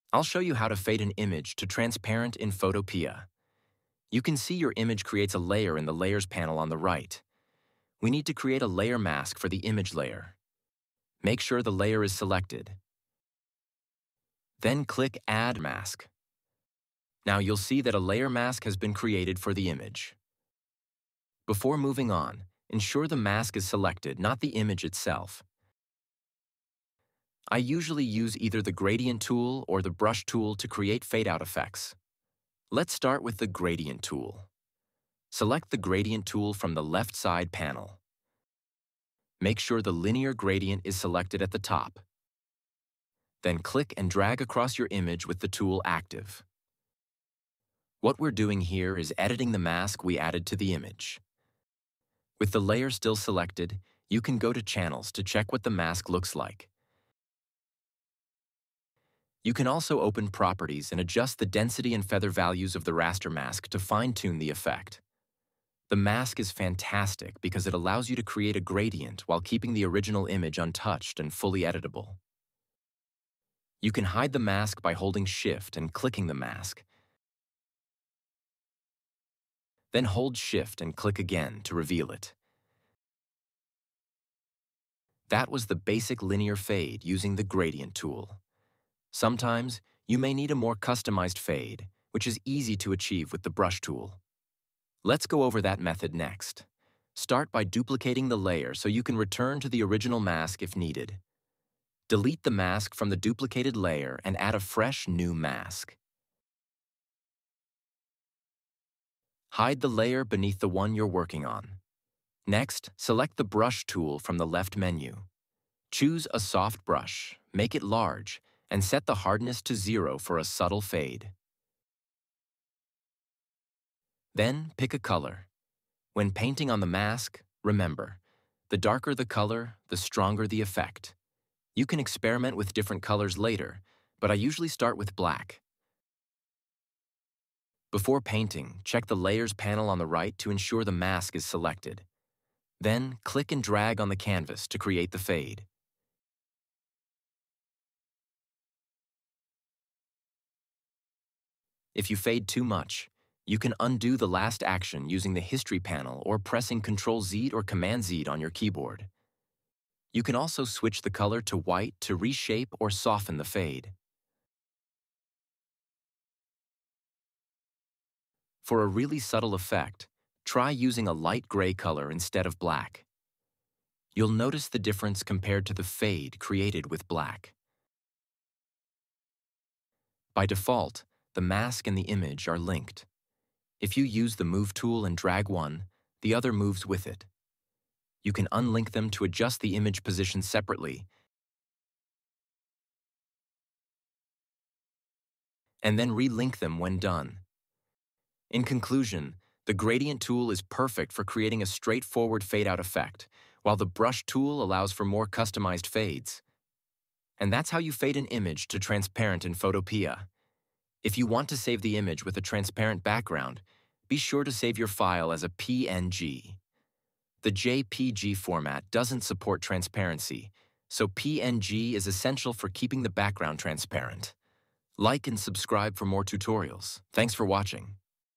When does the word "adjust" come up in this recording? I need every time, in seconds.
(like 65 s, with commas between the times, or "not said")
61 s, 189 s.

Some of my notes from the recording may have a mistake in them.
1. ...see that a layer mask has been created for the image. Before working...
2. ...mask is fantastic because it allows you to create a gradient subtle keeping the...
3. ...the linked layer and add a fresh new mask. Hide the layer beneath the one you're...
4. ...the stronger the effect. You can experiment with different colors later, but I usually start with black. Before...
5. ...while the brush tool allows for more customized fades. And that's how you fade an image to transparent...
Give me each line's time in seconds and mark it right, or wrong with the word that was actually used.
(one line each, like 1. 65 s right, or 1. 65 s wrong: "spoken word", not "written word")
1. 17 s wrong: "moving", not "working"
2. 65 s wrong: "while", not "subtle"
3. 103 s wrong: "duplicated", not "linked"
4. 129 s right
5. 203 s right.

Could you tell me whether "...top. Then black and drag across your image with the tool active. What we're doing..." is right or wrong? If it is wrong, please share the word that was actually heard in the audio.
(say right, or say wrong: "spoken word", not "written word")
wrong: "click", not "black".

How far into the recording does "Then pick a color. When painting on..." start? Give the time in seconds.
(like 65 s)
124 s.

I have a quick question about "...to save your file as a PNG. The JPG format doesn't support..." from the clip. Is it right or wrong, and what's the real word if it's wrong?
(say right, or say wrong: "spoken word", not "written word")
right.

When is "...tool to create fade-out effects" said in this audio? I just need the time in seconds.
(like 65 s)
30 s.